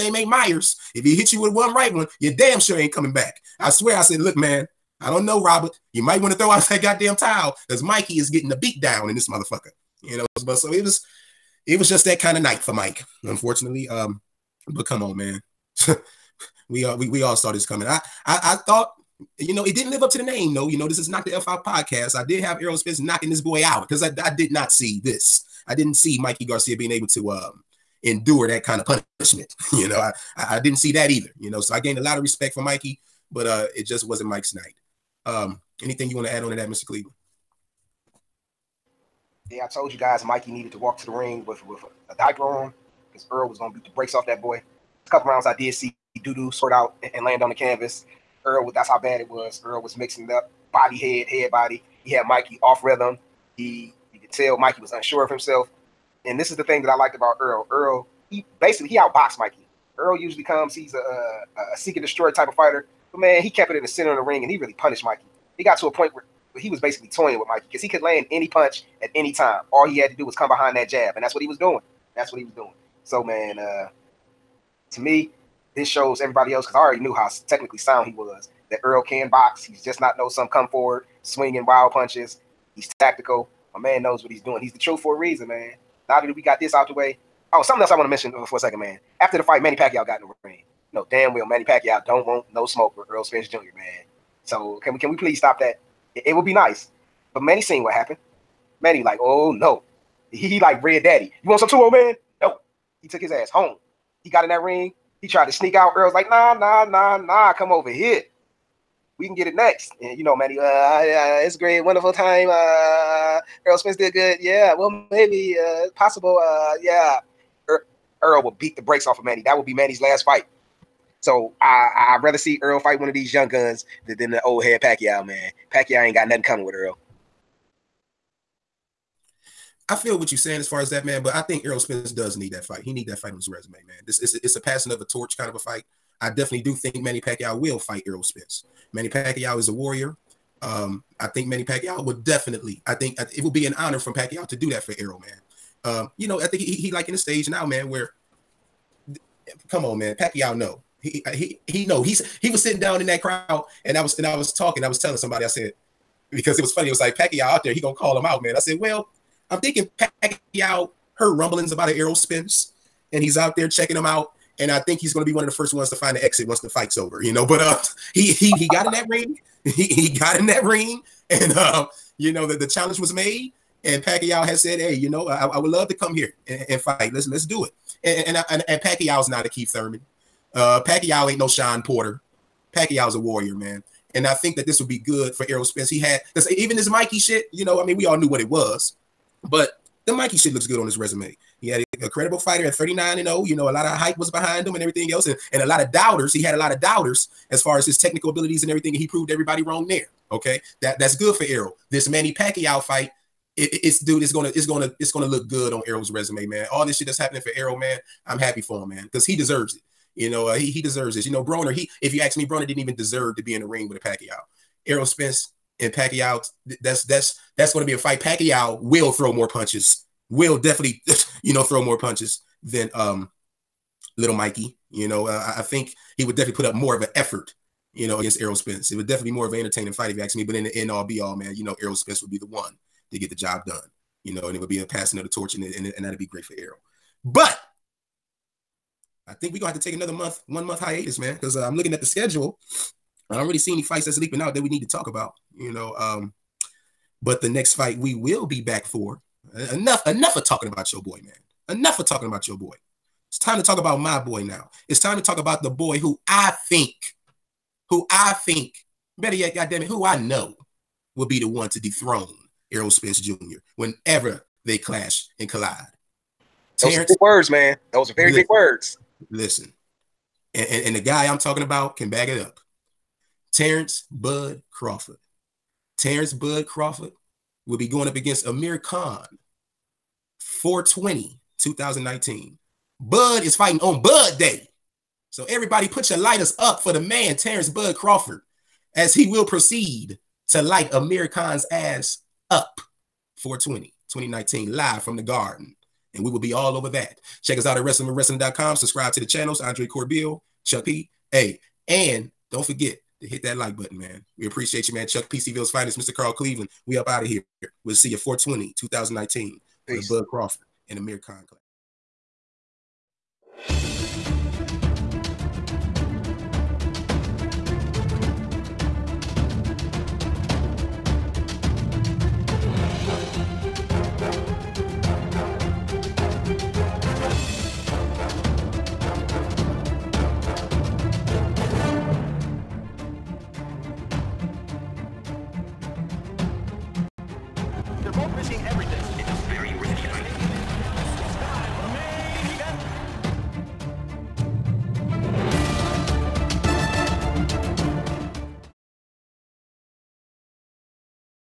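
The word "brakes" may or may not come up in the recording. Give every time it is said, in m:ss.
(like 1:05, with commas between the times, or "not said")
0:43, 1:58.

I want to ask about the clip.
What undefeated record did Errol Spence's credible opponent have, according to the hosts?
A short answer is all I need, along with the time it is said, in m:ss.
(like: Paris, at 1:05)
39 and 0, at 3:12.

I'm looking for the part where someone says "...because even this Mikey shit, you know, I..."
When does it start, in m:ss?
3:06.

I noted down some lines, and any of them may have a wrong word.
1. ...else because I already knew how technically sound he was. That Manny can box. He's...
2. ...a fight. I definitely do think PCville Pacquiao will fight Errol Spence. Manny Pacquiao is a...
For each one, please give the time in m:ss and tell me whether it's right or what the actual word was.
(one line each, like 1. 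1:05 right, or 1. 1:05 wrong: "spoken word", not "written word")
1. 1:16 wrong: "Earl", not "Manny"
2. 2:15 wrong: "Manny", not "PCville".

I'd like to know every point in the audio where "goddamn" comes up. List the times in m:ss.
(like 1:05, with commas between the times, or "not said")
0:06, 4:19.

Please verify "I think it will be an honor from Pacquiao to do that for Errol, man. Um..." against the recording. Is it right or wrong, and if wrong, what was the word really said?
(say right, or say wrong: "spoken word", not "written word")
right.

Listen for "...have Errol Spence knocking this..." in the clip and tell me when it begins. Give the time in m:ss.
0:22.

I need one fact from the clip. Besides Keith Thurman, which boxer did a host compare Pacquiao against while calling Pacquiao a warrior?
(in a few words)
Shawn Porter.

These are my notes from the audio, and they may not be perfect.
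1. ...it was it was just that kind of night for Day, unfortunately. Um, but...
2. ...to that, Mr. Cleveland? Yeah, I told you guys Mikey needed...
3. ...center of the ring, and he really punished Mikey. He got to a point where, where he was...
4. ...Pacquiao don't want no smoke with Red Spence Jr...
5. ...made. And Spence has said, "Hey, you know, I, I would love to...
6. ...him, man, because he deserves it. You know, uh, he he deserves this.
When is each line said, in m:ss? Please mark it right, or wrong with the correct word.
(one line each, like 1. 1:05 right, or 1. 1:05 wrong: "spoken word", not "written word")
1. 0:10 wrong: "Mike", not "Day"
2. 0:36 right
3. 1:03 right
4. 1:31 wrong: "Earl", not "Red"
5. 2:53 wrong: "Pacquiao", not "Spence"
6. 3:28 right.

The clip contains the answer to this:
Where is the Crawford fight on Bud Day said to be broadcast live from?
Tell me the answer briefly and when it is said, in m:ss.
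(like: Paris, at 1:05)
the Garden, at 4:55.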